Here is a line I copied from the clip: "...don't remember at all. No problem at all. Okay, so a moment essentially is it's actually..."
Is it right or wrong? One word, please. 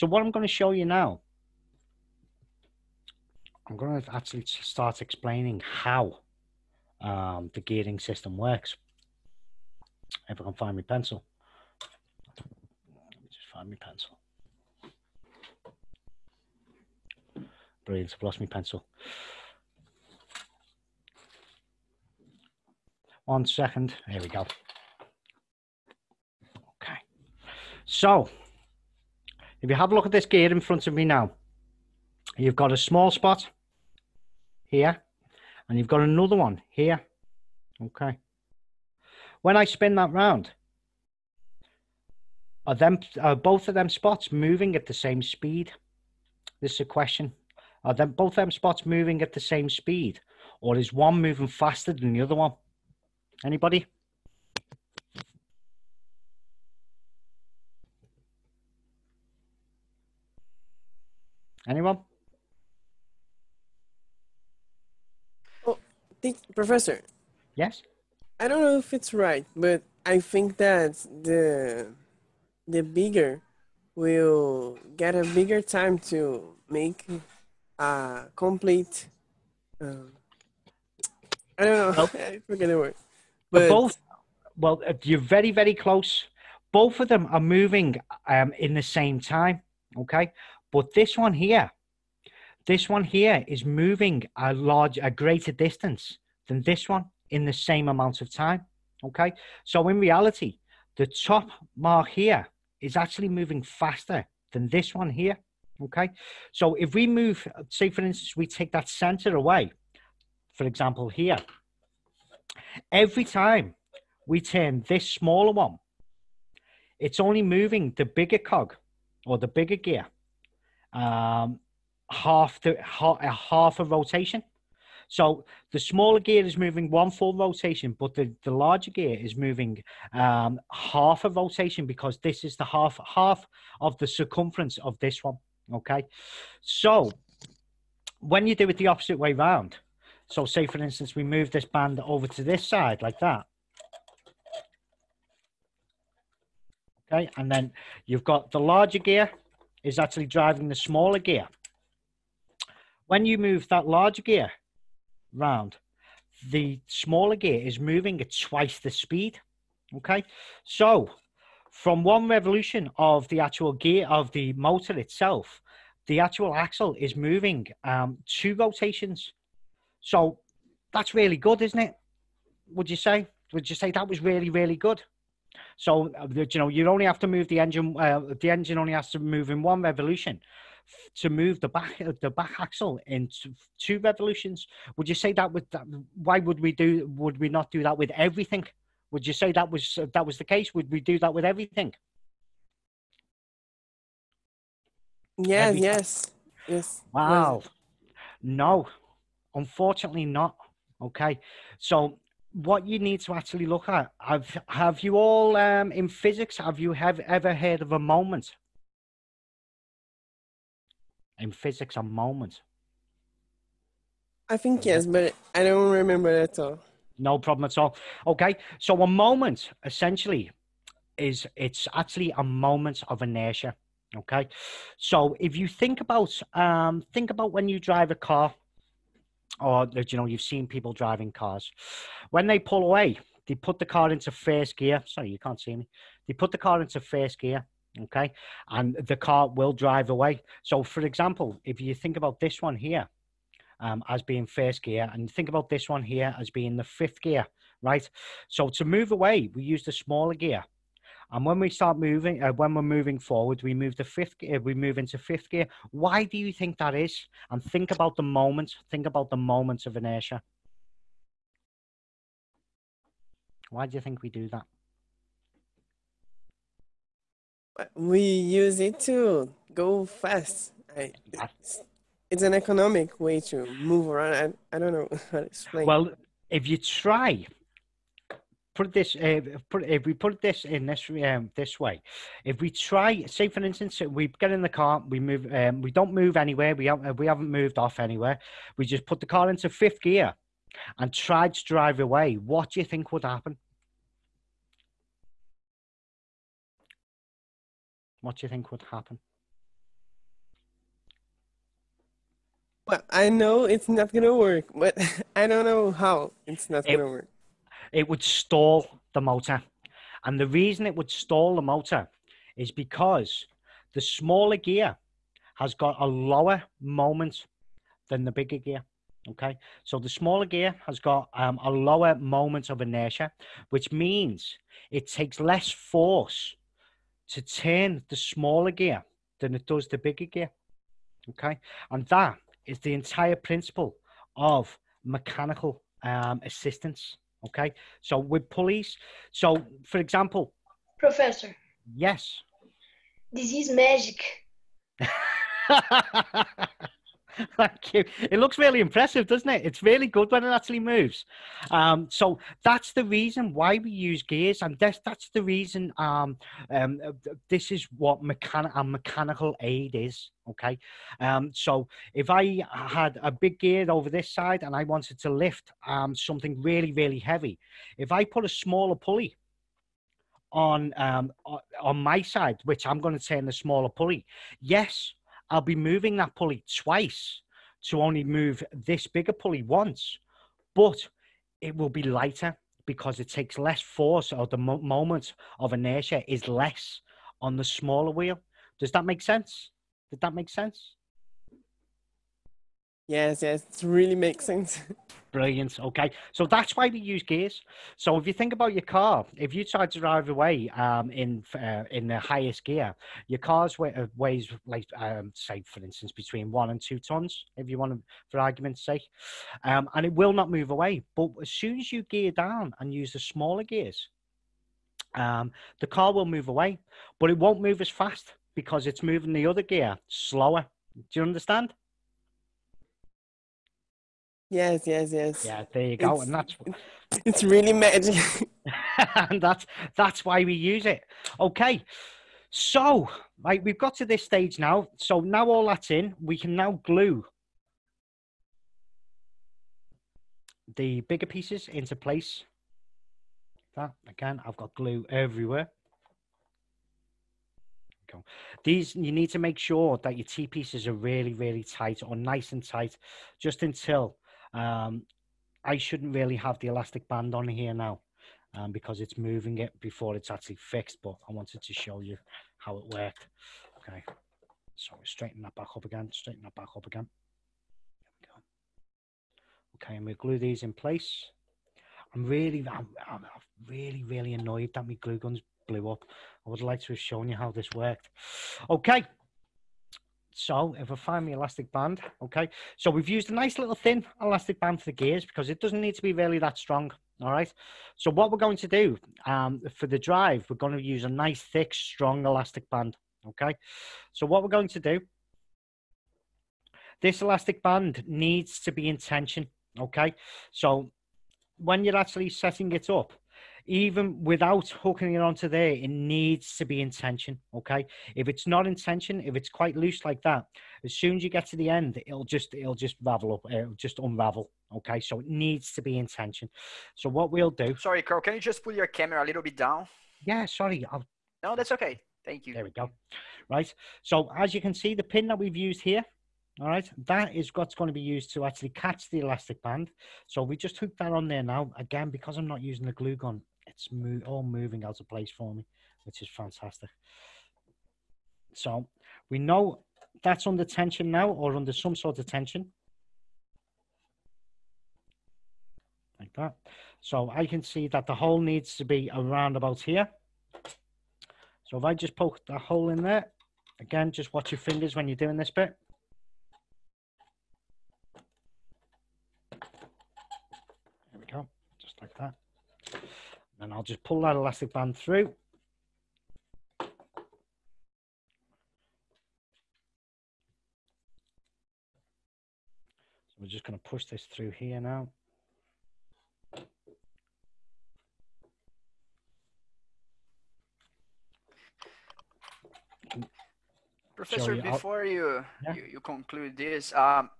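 right.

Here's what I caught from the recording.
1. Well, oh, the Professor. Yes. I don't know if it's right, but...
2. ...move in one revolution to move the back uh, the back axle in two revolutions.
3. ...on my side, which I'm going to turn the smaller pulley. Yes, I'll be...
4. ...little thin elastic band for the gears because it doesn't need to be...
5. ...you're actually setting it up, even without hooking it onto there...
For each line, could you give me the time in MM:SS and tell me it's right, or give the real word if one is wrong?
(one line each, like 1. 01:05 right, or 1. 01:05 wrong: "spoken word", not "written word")
1. 01:05 right
2. 02:59 right
3. 06:11 right
4. 08:03 right
5. 08:21 right.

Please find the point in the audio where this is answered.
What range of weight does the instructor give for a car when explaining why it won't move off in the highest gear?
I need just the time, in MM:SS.
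06:46.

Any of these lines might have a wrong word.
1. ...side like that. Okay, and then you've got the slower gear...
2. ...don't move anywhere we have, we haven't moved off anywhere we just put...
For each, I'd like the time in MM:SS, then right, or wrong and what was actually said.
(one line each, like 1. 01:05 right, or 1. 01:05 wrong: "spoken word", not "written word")
1. 02:22 wrong: "larger", not "slower"
2. 04:45 right.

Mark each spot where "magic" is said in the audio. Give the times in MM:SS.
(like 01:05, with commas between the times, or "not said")
05:43, 07:07.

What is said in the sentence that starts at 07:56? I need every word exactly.
I would like to have shown you how this worked.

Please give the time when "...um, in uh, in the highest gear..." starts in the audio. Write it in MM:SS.
06:40.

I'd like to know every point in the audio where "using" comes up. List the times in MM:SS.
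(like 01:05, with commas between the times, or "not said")
08:52.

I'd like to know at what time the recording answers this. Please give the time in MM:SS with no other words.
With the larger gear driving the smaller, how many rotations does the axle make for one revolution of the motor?
02:48.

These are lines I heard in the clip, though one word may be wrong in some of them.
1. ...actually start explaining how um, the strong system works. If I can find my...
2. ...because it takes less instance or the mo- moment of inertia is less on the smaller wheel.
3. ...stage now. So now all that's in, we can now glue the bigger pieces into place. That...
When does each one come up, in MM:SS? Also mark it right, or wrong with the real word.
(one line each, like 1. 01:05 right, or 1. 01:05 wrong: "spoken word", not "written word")
1. 00:04 wrong: "gearing", not "strong"
2. 06:22 wrong: "force", not "instance"
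3. 07:14 right.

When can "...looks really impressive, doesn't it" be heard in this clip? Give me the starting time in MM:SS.
05:48.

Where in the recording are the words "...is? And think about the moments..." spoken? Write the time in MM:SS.
04:16.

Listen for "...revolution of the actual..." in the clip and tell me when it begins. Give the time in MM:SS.
02:42.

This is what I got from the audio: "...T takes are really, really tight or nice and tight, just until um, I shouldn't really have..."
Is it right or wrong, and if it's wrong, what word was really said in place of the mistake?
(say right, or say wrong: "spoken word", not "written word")
wrong: "pieces", not "takes".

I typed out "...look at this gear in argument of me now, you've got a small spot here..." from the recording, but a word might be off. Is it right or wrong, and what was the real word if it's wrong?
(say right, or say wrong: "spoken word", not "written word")
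wrong: "front", not "argument".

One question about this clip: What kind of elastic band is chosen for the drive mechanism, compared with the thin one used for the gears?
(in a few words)
Thick, strong elastic band.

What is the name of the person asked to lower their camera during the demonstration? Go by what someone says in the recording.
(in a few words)
Carl.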